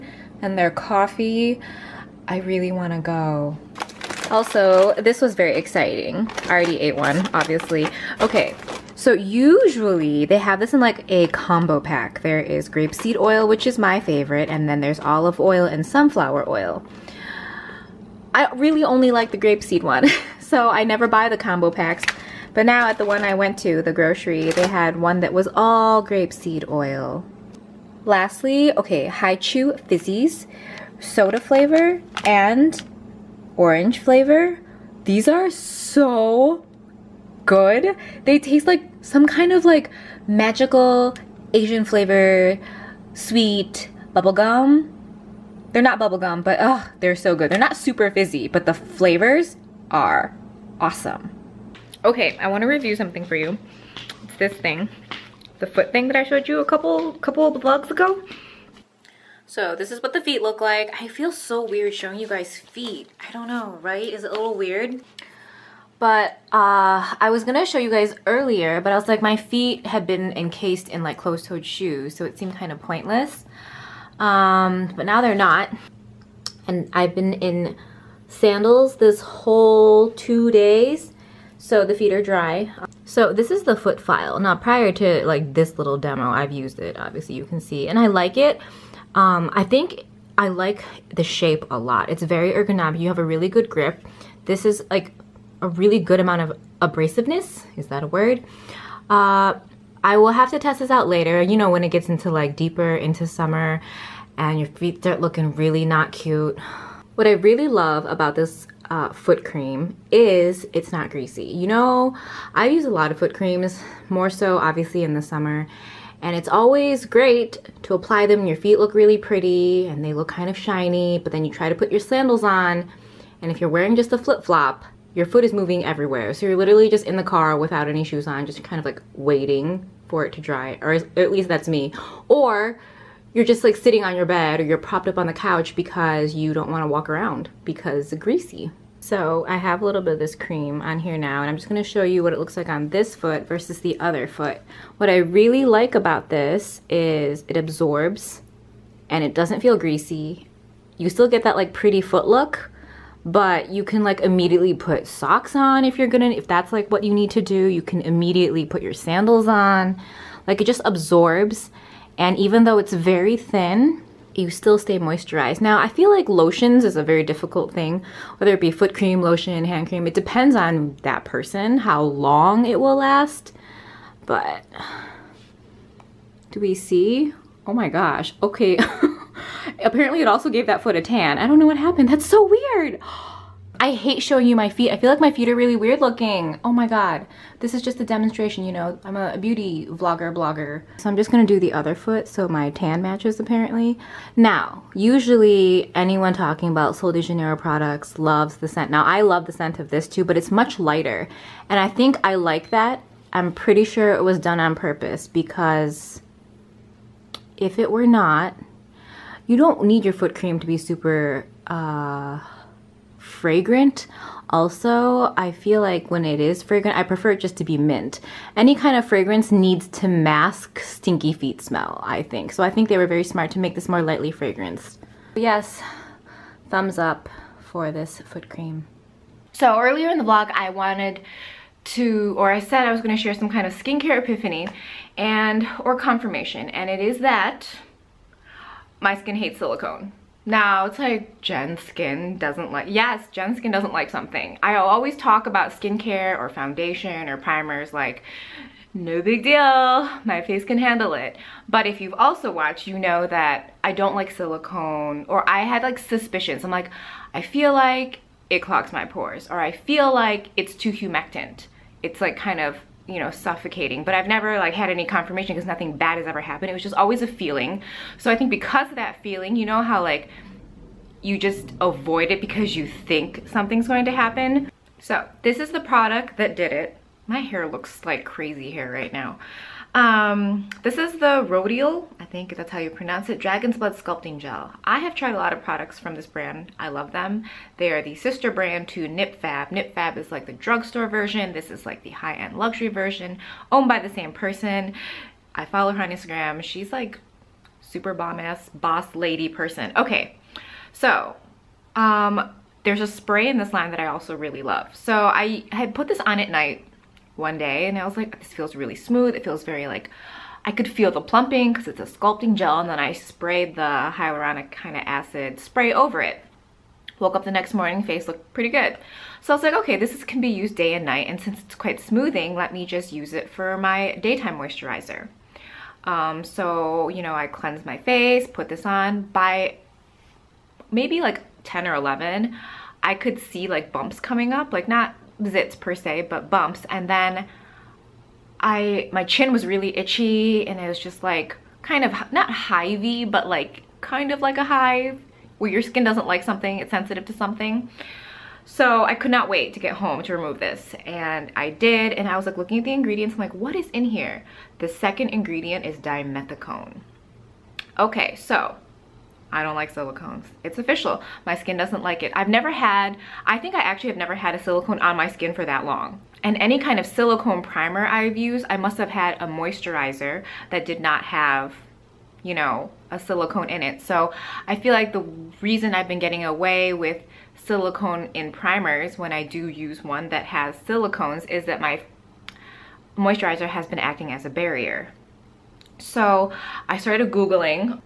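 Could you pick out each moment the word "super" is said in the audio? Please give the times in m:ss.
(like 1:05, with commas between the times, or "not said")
0:47, 3:30, 4:57.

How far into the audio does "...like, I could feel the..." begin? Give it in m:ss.
5:09.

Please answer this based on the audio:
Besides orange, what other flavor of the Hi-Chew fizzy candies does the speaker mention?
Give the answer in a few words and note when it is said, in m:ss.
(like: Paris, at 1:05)
soda, at 0:30.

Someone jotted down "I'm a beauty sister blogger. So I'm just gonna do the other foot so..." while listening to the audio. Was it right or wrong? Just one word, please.
wrong.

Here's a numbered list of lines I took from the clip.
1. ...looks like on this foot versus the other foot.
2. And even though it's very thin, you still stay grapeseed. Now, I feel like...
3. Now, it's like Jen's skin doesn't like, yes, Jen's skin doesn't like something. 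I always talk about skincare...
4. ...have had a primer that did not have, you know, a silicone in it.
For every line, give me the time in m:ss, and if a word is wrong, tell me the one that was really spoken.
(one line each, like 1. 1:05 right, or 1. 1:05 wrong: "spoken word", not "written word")
1. 2:22 right
2. 2:42 wrong: "moisturized", not "grapeseed"
3. 4:00 right
4. 6:08 wrong: "moisturizer", not "primer".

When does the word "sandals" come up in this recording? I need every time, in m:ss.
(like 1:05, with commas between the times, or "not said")
1:18, 2:01, 2:38.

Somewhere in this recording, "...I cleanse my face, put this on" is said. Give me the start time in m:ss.
5:27.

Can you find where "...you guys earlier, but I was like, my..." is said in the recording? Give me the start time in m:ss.
1:07.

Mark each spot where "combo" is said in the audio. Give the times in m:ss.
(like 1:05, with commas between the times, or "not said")
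0:11, 0:21.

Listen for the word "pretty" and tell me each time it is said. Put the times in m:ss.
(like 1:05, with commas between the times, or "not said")
1:59, 2:31, 3:23, 5:18.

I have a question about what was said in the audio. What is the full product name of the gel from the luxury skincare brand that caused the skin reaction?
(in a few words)
Dragon's Blood Sculpting Gel.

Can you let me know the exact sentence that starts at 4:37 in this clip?
My hair looks like crazy hair right now.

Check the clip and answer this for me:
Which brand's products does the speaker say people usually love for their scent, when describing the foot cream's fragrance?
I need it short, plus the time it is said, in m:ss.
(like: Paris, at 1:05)
Sol de Janeiro, at 3:16.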